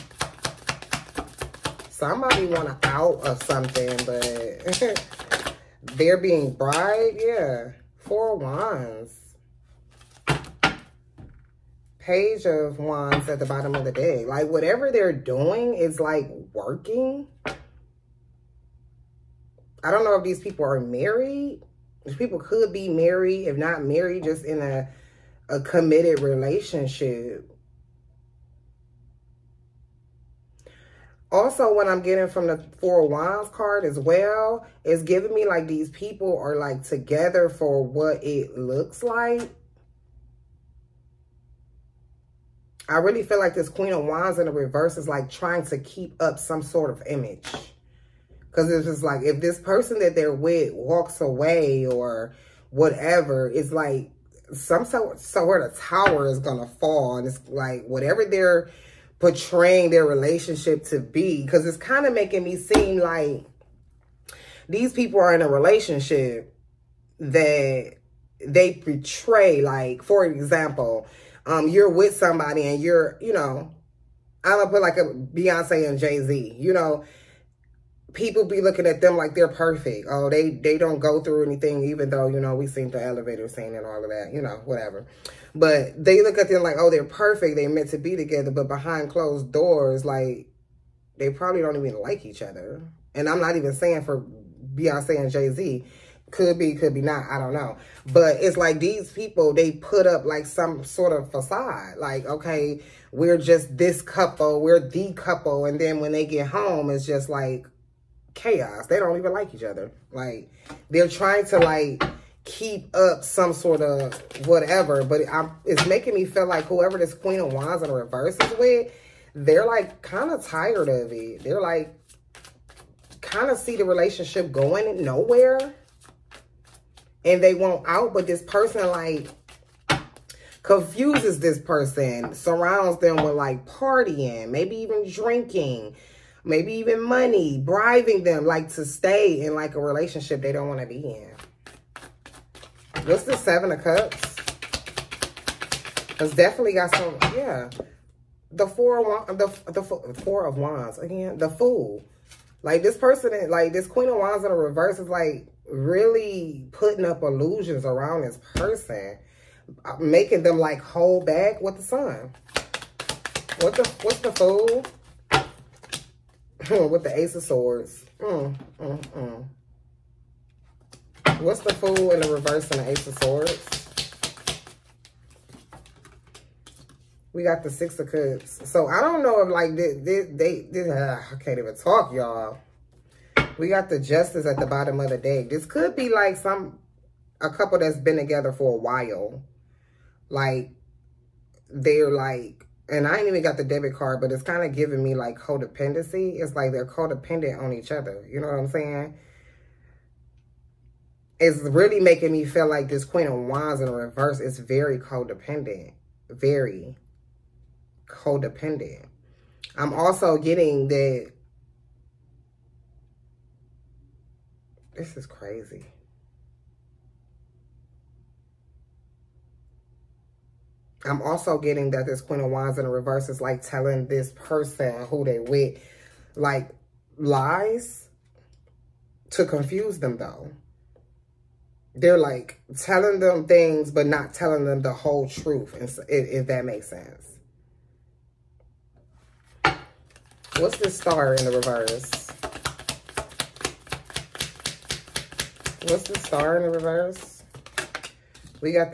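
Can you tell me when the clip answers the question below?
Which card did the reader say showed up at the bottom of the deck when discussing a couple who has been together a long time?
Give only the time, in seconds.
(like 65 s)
183 s.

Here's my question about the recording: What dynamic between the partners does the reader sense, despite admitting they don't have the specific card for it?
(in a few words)
Codependency.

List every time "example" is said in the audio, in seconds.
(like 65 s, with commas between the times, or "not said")
70 s.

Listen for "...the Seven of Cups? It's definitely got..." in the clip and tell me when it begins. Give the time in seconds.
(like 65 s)
143 s.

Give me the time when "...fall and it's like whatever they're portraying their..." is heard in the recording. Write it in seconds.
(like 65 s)
56 s.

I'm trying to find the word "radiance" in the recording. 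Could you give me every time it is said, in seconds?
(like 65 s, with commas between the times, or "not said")
not said.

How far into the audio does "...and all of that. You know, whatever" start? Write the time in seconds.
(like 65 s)
83 s.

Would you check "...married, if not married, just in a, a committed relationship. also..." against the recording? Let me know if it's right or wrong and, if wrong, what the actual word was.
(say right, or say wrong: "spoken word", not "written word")
right.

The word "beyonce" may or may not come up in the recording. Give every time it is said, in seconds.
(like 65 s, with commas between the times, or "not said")
75 s, 94 s.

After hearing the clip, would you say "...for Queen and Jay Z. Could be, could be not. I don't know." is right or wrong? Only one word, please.
wrong.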